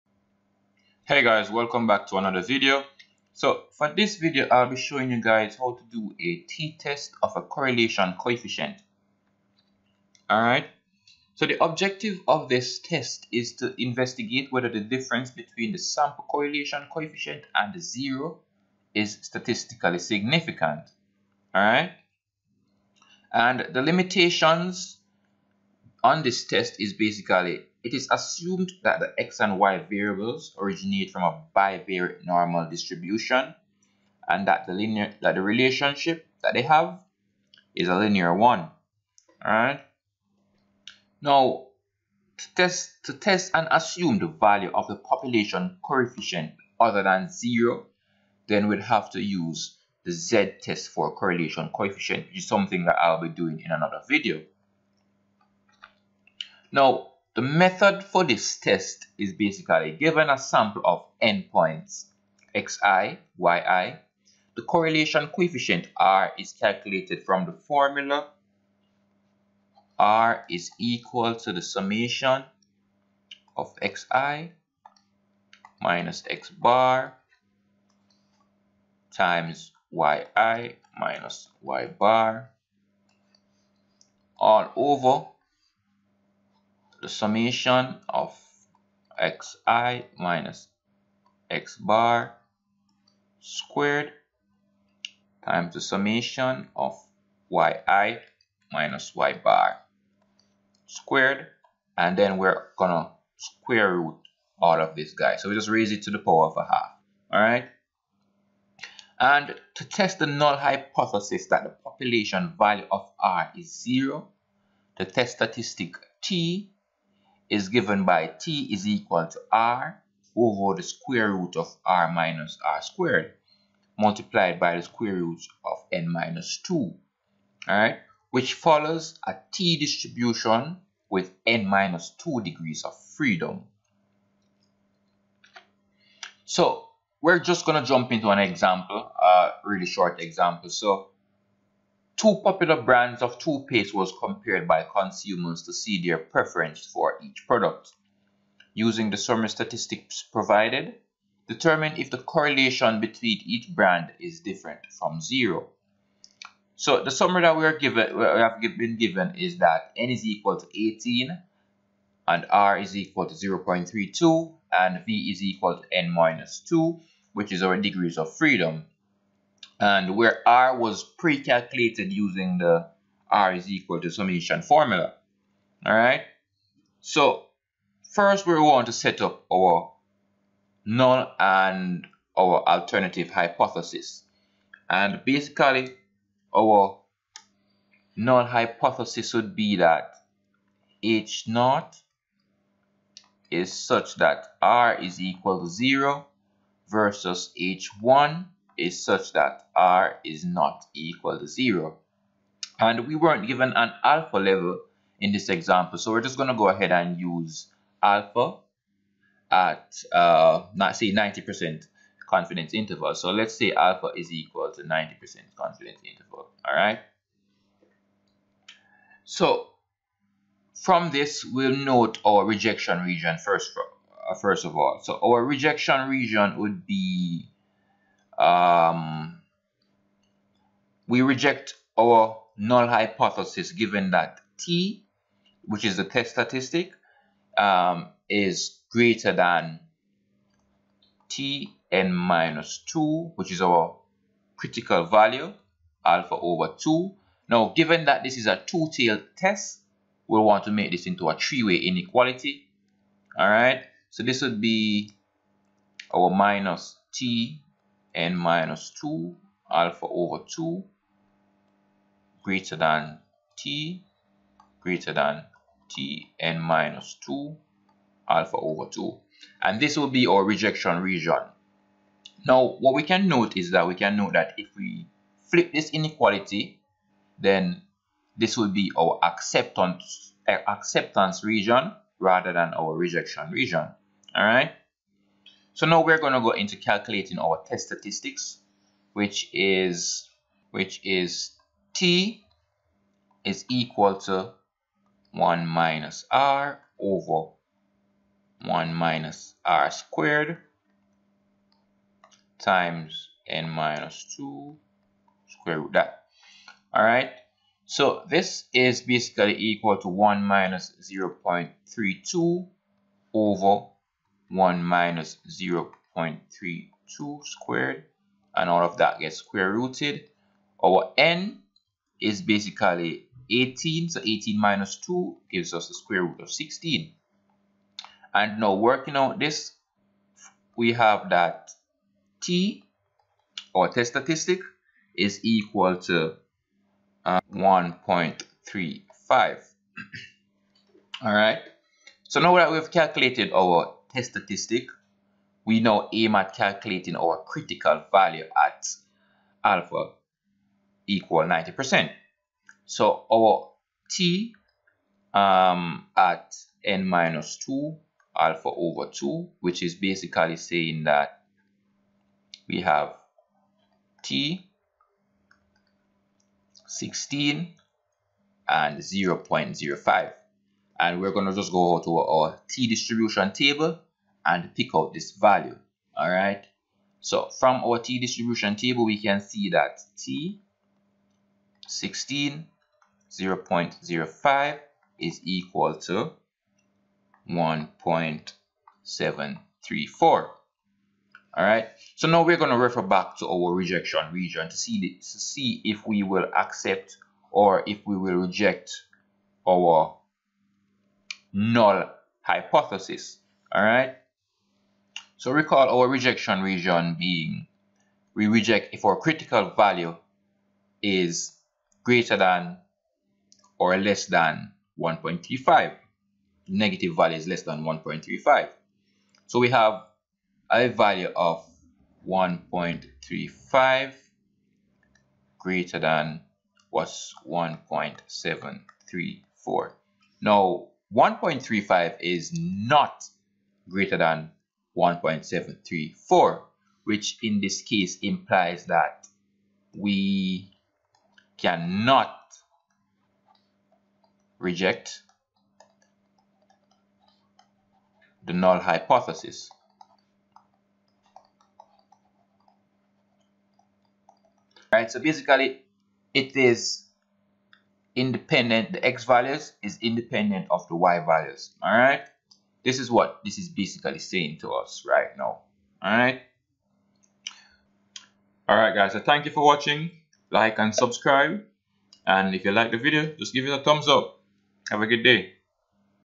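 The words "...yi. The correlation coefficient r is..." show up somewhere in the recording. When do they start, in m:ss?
1:03.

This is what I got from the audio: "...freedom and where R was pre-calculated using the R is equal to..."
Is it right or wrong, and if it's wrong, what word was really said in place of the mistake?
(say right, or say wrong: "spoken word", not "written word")
right.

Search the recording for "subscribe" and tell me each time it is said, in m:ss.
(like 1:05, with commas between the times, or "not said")
7:50.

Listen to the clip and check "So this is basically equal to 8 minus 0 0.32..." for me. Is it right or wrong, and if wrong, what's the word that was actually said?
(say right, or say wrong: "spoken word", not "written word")
wrong: "1", not "8".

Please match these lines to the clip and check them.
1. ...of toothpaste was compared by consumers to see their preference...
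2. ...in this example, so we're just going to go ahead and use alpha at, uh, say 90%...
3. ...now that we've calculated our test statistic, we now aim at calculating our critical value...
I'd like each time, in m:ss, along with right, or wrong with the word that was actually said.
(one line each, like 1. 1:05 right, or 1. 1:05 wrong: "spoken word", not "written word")
1. 2:23 right
2. 3:25 right
3. 5:42 right.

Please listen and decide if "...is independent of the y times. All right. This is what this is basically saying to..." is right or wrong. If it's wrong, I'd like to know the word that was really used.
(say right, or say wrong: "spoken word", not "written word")
wrong: "values", not "times".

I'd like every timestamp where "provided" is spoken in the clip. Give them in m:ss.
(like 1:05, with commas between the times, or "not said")
2:30.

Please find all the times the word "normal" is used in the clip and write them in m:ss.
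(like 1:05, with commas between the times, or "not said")
0:32.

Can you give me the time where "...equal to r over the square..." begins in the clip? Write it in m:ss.
1:58.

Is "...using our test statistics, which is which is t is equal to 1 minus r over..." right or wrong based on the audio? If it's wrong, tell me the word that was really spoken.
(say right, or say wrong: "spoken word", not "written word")
wrong: "calculating", not "using".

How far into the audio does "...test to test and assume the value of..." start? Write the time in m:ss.
0:42.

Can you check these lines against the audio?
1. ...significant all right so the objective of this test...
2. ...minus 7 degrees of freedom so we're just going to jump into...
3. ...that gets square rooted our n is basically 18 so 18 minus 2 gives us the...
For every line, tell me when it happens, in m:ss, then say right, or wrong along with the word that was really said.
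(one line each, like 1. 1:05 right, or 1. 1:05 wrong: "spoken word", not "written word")
1. 0:08 wrong: "coefficient", not "significant"
2. 2:11 wrong: "2", not "7"
3. 5:18 right.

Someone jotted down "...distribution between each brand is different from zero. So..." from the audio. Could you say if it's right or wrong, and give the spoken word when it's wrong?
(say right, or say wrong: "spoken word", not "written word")
wrong: "correlation", not "distribution".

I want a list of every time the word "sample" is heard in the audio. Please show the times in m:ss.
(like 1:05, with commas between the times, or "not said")
0:15, 1:00.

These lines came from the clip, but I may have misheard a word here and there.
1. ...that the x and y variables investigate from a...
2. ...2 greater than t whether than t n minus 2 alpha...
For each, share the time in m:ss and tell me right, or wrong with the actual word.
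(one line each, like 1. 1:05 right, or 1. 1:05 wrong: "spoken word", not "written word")
1. 0:28 wrong: "originate", not "investigate"
2. 4:20 wrong: "greater", not "whether".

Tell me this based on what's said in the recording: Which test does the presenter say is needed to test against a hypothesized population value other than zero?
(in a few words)
z test for correlation coefficient.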